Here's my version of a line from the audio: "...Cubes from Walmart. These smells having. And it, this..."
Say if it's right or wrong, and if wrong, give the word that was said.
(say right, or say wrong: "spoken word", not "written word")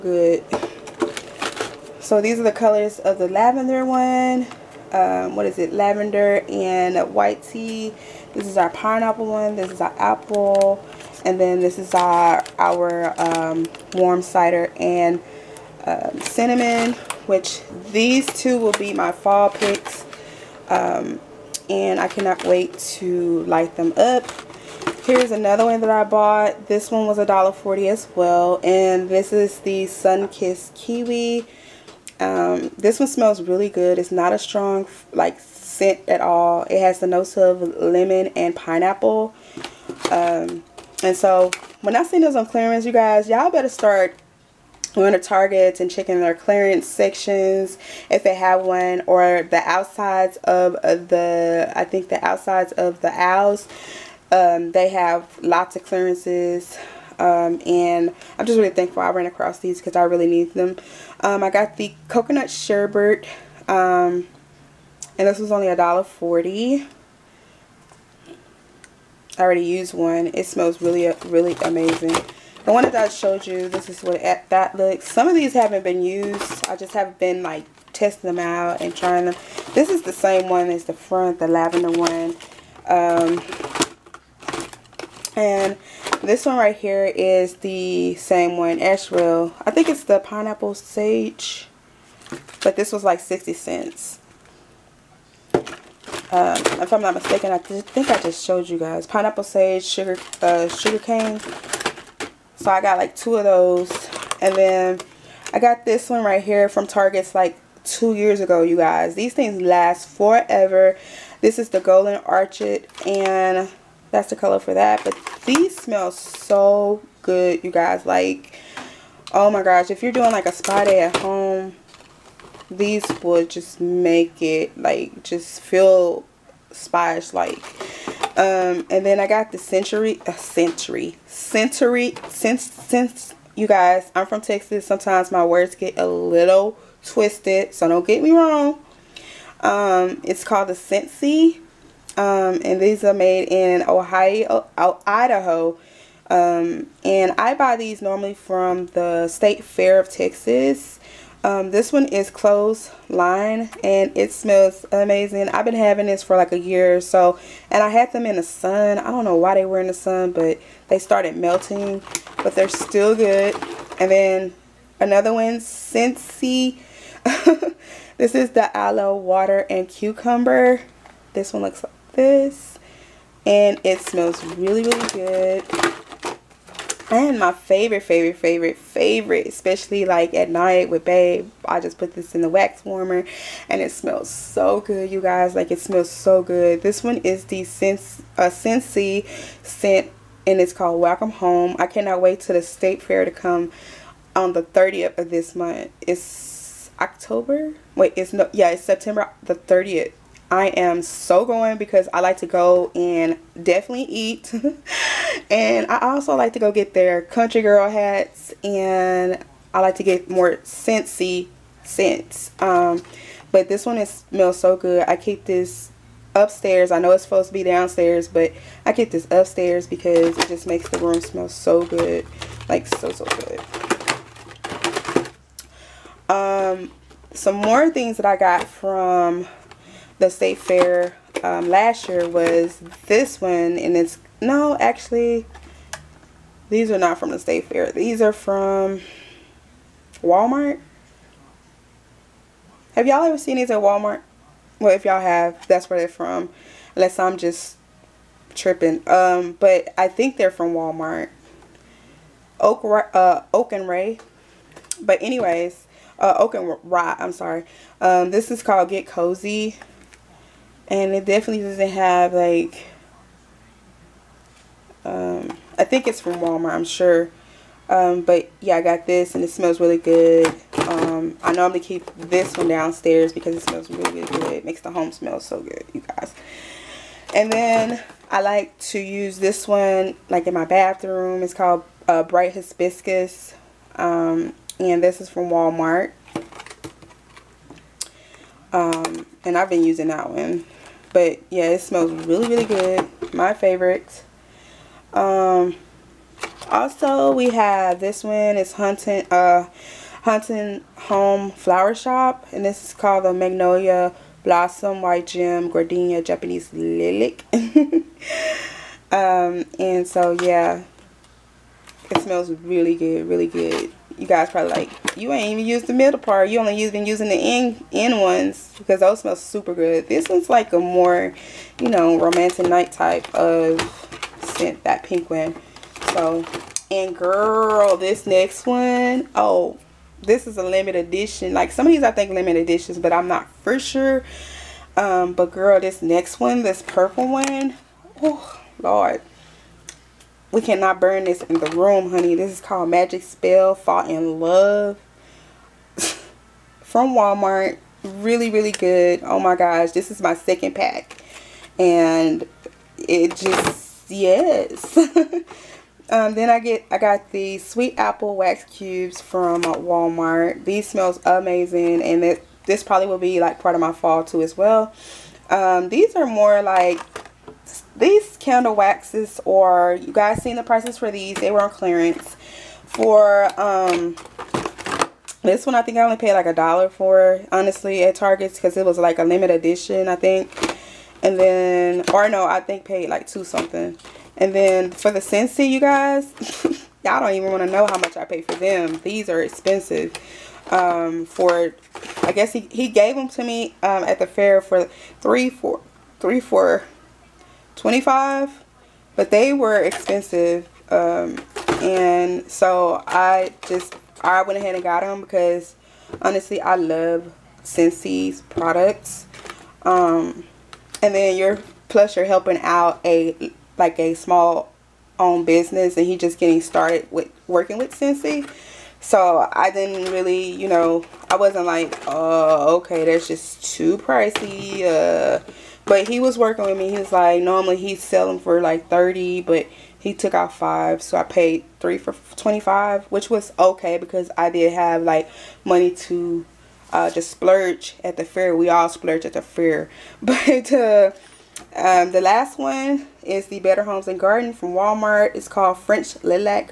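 wrong: "amazing", not "having".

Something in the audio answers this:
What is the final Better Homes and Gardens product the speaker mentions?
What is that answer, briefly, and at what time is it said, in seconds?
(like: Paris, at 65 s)
French Lilac, at 445 s.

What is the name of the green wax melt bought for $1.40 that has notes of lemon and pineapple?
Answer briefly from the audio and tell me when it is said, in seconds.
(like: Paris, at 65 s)
Sunkissed Kiwi, at 29 s.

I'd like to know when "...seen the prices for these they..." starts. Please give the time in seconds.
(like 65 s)
370 s.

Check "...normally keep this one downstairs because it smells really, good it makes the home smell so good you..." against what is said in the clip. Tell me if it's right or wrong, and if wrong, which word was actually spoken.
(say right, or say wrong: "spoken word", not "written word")
right.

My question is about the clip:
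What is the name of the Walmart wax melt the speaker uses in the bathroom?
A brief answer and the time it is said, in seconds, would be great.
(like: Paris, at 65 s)
Bright Hibiscus, at 282 s.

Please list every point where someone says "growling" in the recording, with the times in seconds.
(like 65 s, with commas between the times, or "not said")
not said.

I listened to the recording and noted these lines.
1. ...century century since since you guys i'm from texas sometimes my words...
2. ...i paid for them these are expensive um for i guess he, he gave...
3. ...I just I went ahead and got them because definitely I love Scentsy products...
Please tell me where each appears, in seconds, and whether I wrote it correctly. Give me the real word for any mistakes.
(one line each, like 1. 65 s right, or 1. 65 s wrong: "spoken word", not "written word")
1. 130 s right
2. 388 s right
3. 403 s wrong: "honestly", not "definitely".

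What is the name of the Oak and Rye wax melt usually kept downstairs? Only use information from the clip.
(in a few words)
Get Cozy.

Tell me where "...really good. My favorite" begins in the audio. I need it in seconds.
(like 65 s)
292 s.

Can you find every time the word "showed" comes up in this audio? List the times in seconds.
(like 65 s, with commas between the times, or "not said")
73 s, 98 s.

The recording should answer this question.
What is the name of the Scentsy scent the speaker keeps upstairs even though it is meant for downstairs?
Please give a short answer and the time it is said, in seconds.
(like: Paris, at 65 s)
Welcome Home, at 190 s.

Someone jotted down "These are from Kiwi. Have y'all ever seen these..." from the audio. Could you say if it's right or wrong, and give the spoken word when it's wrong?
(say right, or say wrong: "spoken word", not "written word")
wrong: "Walmart", not "Kiwi".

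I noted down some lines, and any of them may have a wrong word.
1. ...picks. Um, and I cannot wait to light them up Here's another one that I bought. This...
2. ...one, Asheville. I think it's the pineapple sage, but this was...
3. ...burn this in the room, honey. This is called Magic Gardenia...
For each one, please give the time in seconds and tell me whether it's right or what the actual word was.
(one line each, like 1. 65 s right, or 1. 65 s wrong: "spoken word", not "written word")
1. 19 s right
2. 88 s right
3. 341 s wrong: "Spell", not "Gardenia".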